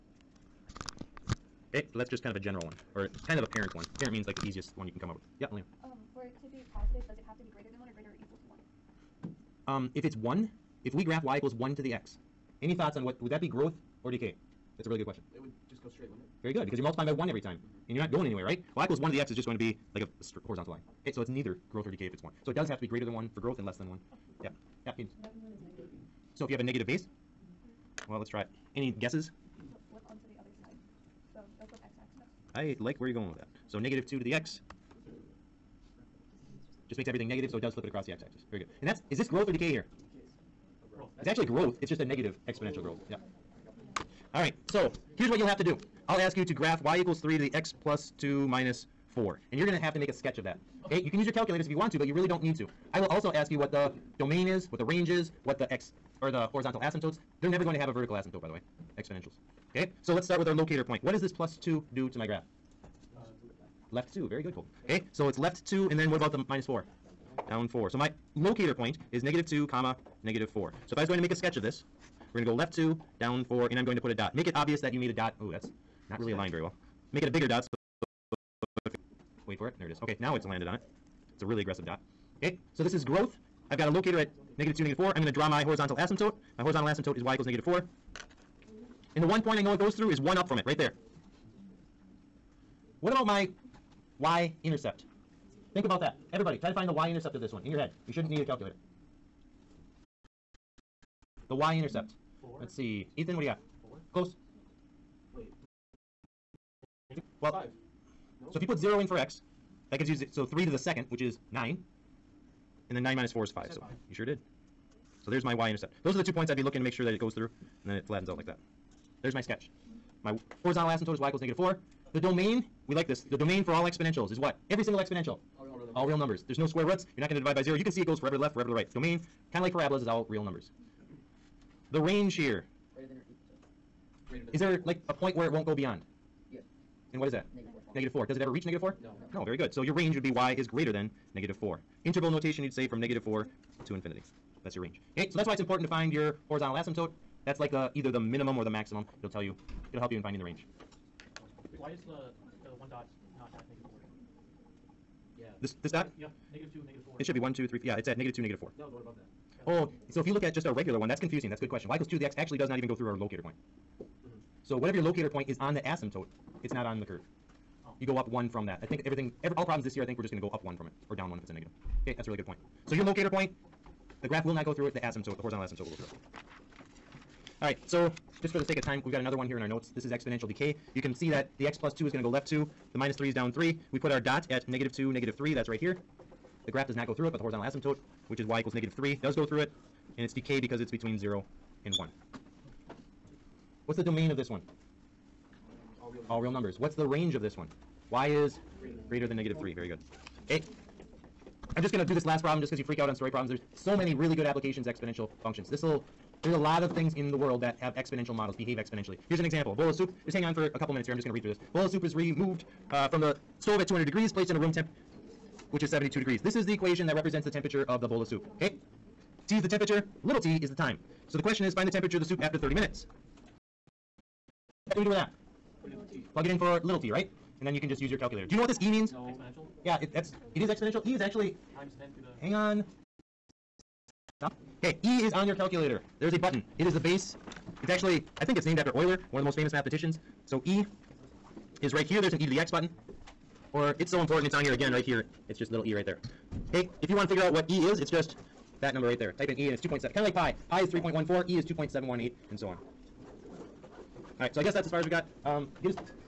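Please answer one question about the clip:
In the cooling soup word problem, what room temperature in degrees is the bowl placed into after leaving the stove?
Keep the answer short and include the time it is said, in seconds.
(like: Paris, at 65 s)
72 degrees, at 215 s.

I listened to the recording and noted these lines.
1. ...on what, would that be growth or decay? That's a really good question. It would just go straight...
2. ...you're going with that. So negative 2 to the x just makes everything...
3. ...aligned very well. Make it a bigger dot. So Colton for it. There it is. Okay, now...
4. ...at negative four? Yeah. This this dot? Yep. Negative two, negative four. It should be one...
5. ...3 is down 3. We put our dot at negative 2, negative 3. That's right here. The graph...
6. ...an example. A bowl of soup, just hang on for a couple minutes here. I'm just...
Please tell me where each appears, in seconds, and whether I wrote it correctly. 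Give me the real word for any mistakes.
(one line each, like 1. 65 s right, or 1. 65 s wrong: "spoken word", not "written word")
1. 12 s right
2. 33 s right
3. 76 s wrong: "Wait", not "Colton"
4. 153 s right
5. 183 s right
6. 209 s right.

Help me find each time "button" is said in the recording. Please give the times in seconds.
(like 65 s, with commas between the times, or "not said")
236 s, 242 s.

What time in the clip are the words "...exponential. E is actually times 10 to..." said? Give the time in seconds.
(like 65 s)
230 s.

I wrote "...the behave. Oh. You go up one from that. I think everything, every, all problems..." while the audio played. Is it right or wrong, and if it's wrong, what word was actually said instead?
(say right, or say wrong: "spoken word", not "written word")
wrong: "curve", not "behave".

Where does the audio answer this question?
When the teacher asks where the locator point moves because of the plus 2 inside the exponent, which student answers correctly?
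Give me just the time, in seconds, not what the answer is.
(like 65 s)
64 s.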